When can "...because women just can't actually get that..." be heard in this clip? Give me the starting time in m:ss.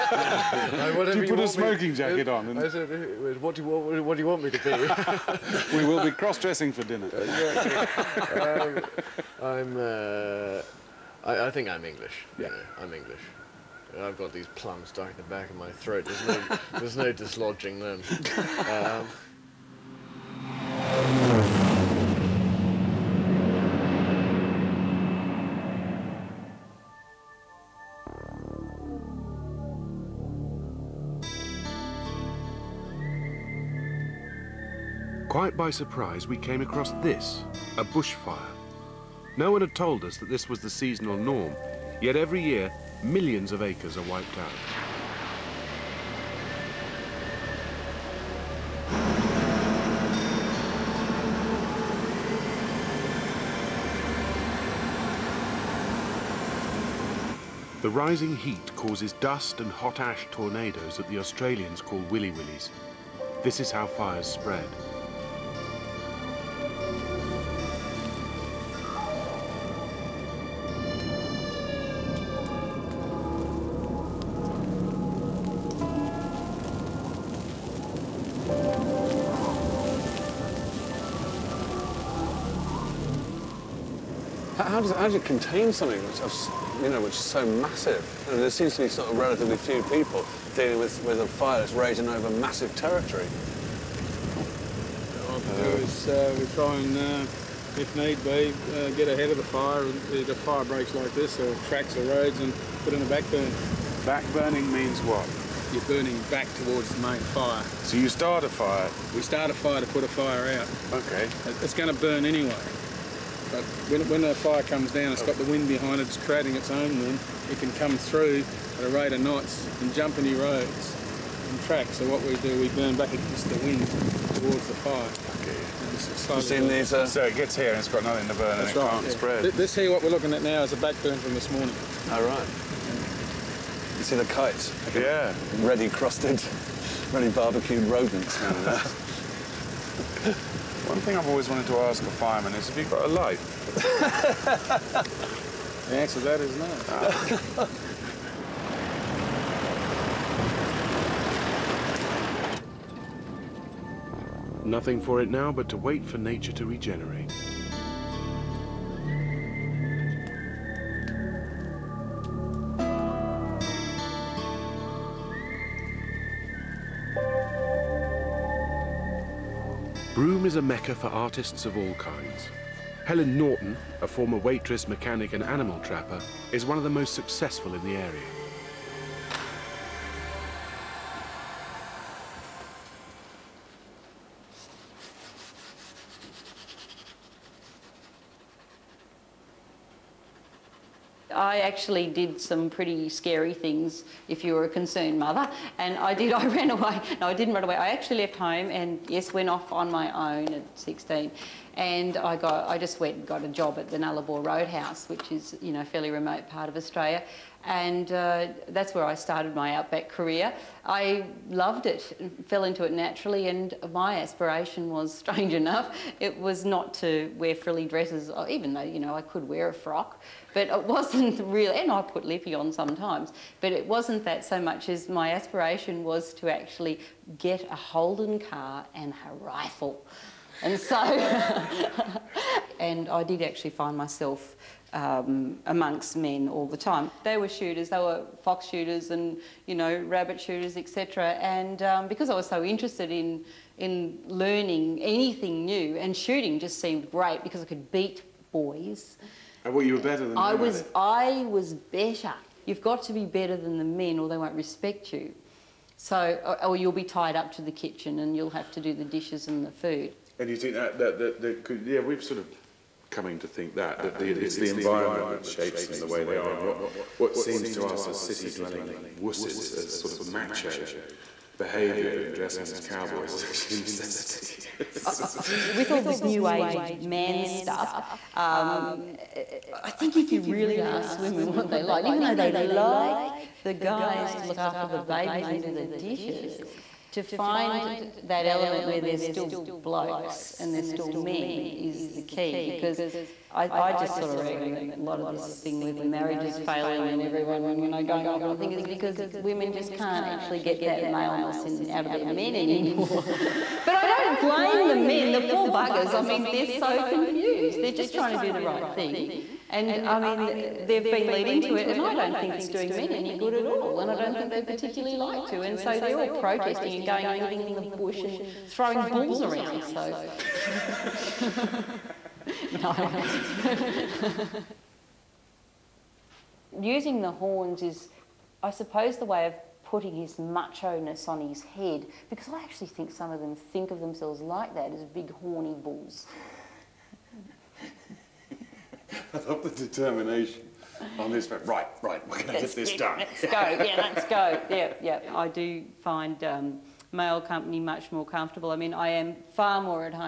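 4:58.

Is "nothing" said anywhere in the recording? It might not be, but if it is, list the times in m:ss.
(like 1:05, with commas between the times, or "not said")
2:08, 2:34.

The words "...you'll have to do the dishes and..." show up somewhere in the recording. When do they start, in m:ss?
4:18.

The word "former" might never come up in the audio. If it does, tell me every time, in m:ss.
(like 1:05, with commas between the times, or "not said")
2:54.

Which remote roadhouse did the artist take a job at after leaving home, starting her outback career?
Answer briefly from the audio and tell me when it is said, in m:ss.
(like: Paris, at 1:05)
Nullarbor Roadhouse, at 3:23.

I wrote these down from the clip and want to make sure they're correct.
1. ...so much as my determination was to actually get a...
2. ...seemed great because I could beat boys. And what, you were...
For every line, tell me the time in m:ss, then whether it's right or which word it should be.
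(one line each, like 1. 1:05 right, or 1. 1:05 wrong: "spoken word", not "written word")
1. 3:44 wrong: "aspiration", not "determination"
2. 4:06 right.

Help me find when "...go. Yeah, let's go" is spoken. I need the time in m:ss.
5:43.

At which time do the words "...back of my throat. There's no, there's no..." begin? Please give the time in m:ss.
0:15.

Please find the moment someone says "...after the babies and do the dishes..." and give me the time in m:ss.
4:44.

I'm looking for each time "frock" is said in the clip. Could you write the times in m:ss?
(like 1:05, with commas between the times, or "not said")
3:39.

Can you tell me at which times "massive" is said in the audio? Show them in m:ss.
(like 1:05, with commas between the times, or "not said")
1:27, 1:32.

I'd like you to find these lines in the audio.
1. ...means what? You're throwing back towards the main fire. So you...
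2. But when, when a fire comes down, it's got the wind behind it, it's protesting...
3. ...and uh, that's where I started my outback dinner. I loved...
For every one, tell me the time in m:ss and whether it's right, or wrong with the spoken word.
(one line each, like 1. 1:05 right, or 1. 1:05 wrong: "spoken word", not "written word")
1. 1:44 wrong: "burning", not "throwing"
2. 1:53 wrong: "creating", not "protesting"
3. 3:27 wrong: "career", not "dinner".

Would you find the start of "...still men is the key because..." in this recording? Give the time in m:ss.
4:50.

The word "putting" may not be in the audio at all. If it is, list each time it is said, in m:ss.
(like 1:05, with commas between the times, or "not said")
5:29.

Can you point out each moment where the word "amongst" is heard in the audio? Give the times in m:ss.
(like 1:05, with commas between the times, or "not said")
3:55.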